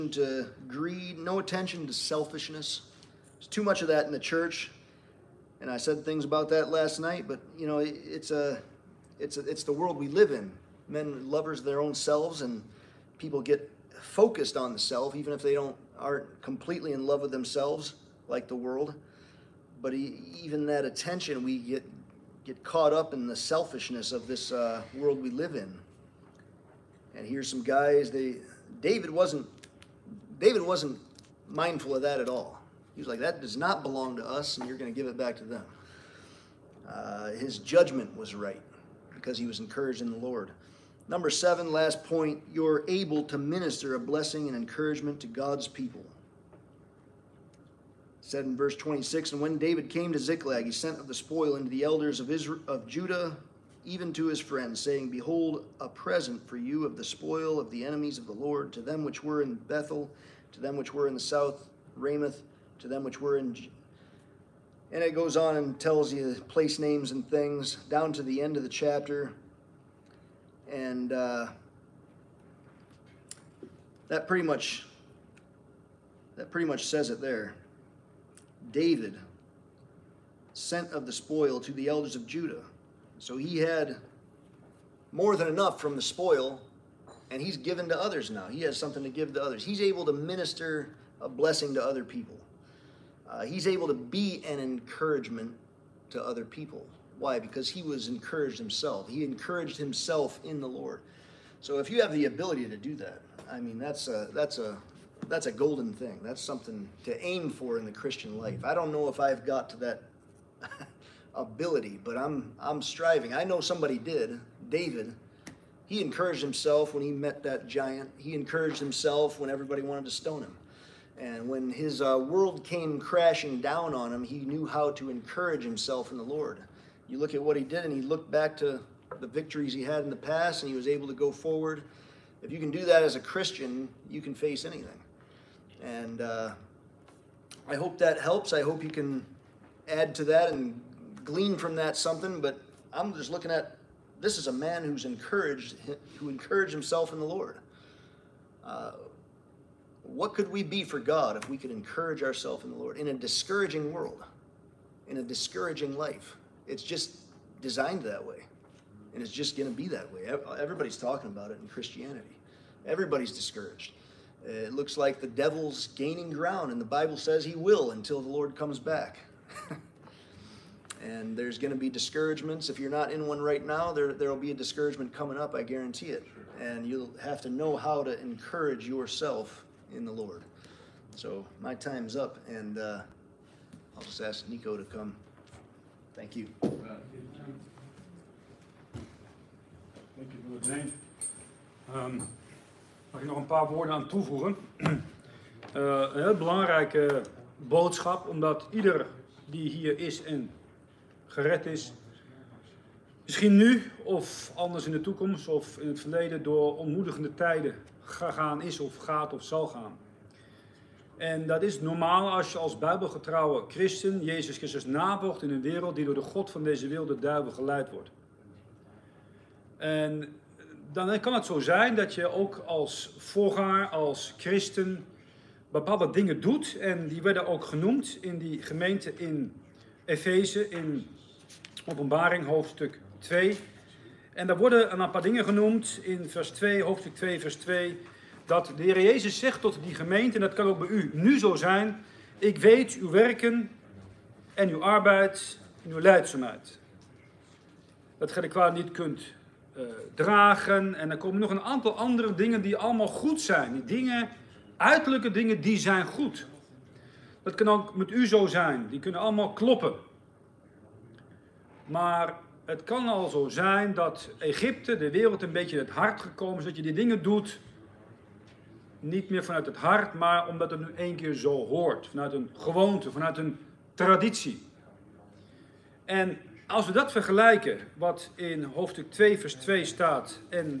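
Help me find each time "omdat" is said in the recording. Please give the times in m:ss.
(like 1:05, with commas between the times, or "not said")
3:18, 4:30.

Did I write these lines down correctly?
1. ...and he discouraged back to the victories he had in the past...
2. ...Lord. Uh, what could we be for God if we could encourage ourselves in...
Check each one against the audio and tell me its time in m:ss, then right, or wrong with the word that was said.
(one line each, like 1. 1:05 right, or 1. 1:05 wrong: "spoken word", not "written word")
1. 2:07 wrong: "looked", not "discouraged"
2. 2:27 right.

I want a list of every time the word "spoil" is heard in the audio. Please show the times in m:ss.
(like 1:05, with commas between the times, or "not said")
0:51, 0:57, 1:21, 1:26.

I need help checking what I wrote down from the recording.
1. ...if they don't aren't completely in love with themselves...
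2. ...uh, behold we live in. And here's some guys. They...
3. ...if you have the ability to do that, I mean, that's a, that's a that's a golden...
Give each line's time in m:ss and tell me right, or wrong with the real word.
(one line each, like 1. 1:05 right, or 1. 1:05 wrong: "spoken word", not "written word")
1. 0:15 right
2. 0:24 wrong: "world", not "behold"
3. 1:41 right.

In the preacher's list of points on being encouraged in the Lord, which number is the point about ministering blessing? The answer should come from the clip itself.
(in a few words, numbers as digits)
7.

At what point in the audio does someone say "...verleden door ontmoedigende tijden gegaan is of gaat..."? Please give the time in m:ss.
3:25.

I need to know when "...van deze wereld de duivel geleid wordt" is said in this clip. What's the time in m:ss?
3:36.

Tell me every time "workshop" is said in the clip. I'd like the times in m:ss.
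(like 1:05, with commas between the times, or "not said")
not said.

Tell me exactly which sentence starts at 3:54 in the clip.
En daar worden een paar dingen genoemd in vers 2, hoofdstuk 2, vers 2.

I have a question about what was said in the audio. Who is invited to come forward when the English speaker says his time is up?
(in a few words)
Nico.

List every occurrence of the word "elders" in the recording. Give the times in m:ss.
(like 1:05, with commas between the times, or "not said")
0:51, 1:21.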